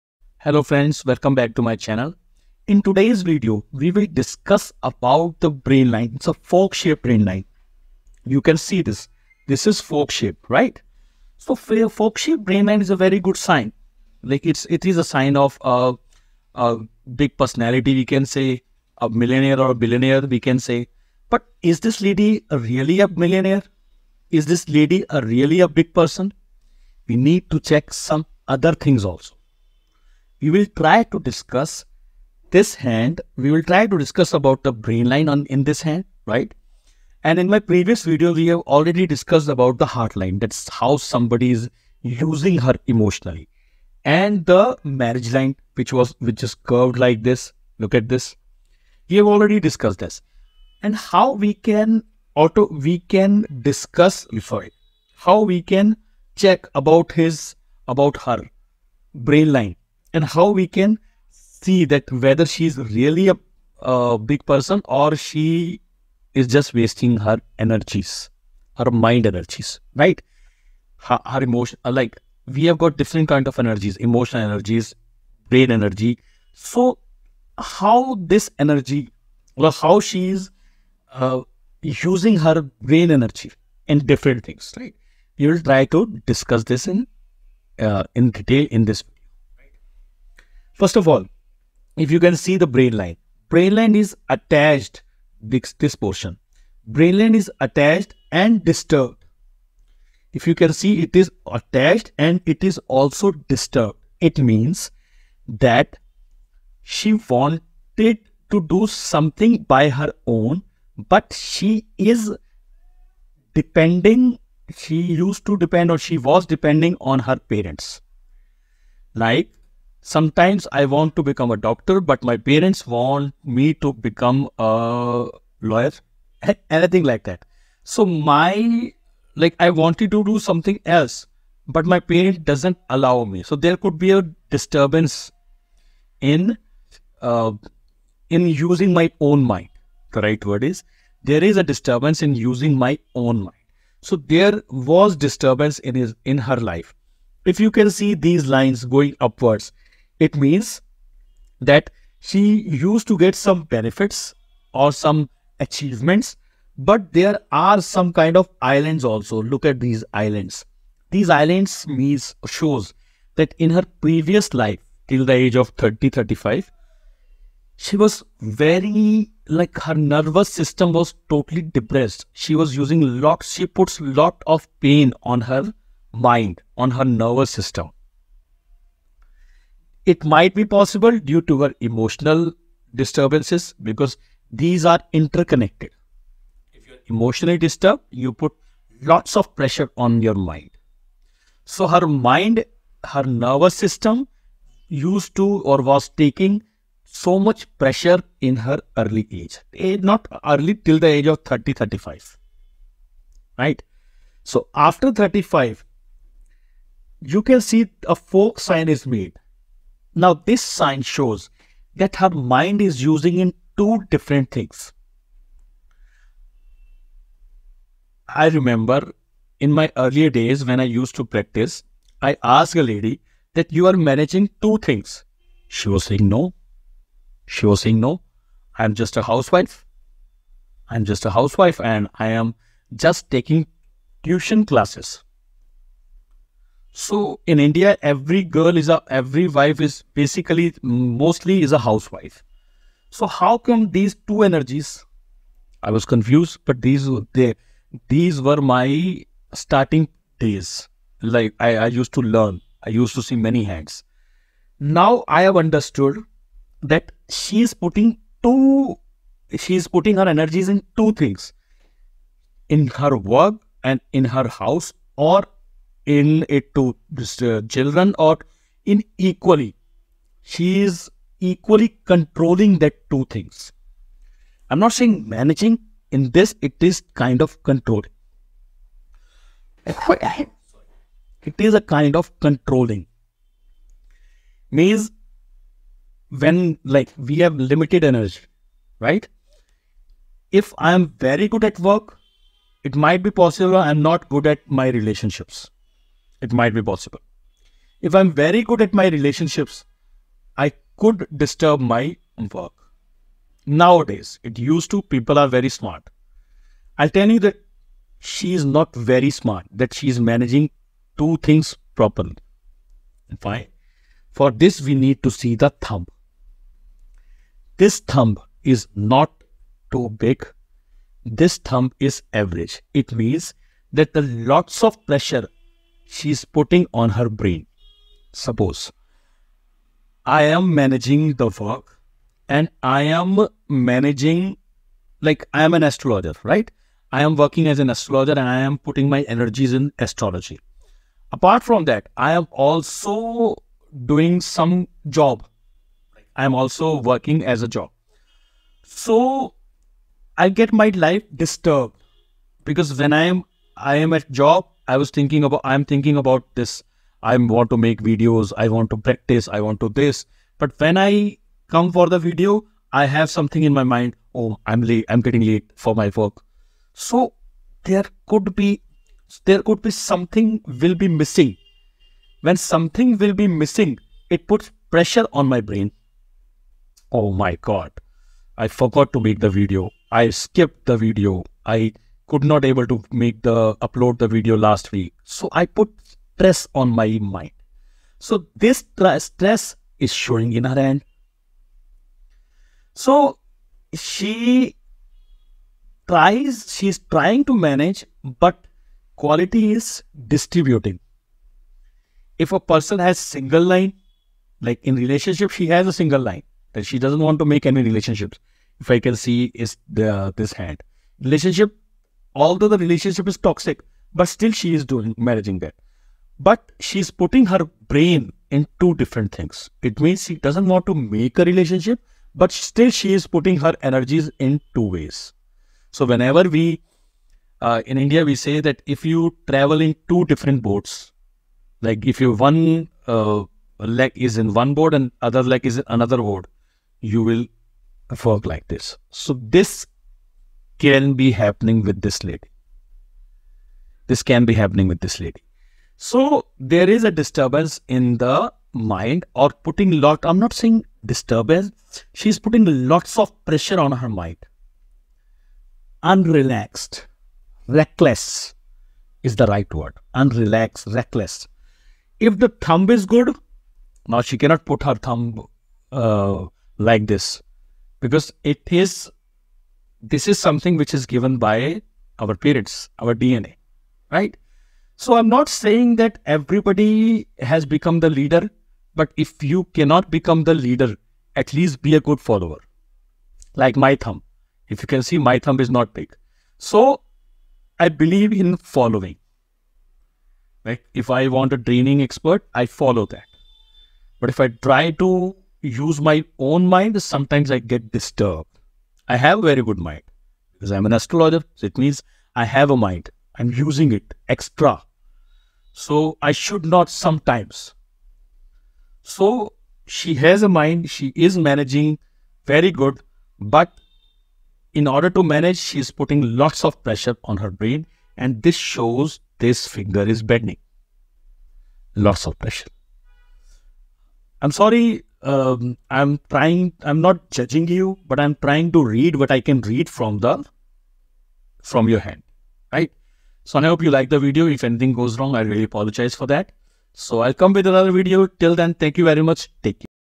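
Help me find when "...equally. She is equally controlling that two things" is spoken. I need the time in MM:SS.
04:29.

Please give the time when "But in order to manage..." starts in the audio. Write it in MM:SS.
08:33.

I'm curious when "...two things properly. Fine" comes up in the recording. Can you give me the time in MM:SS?
05:11.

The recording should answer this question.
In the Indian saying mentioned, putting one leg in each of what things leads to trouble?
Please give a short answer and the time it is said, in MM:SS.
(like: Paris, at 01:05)
Two different boats, at 07:10.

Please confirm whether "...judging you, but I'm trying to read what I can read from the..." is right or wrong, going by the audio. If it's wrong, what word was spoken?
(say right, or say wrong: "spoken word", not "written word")
right.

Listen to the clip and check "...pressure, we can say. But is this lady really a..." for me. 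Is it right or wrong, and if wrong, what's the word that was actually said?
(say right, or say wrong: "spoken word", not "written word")
wrong: "billionaire", not "pressure".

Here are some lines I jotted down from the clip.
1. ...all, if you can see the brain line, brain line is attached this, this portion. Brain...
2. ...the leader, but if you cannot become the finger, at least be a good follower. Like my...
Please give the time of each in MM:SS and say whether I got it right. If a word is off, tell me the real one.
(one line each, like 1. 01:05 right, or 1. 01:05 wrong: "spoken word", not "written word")
1. 01:31 right
2. 07:57 wrong: "leader", not "finger".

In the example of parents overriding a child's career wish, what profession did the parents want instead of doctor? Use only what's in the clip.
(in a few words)
Lawyer.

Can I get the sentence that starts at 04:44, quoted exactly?
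Means when like we have limited energy, right?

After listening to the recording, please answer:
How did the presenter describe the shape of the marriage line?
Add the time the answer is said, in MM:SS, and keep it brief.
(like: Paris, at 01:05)
Curved, at 00:46.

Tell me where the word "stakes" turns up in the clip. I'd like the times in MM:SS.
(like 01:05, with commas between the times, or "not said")
not said.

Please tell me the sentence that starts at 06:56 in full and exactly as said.
But she's putting her brain in two different things.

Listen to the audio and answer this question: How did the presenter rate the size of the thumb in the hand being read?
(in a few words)
Average.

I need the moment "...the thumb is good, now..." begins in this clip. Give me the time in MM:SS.
07:42.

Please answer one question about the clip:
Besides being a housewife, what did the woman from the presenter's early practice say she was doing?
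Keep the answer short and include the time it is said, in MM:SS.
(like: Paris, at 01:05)
Tuition classes, at 03:54.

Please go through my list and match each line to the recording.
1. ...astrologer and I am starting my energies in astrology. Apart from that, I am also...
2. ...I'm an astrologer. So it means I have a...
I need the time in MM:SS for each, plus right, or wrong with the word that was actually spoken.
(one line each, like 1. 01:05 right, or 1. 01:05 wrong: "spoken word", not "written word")
1. 05:37 wrong: "putting", not "starting"
2. 08:20 right.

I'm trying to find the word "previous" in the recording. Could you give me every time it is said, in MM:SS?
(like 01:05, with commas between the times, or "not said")
00:37, 02:43.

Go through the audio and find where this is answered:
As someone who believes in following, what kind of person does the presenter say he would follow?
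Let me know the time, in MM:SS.
08:11.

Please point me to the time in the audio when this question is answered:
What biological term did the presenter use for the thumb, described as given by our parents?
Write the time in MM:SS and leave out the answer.
07:53.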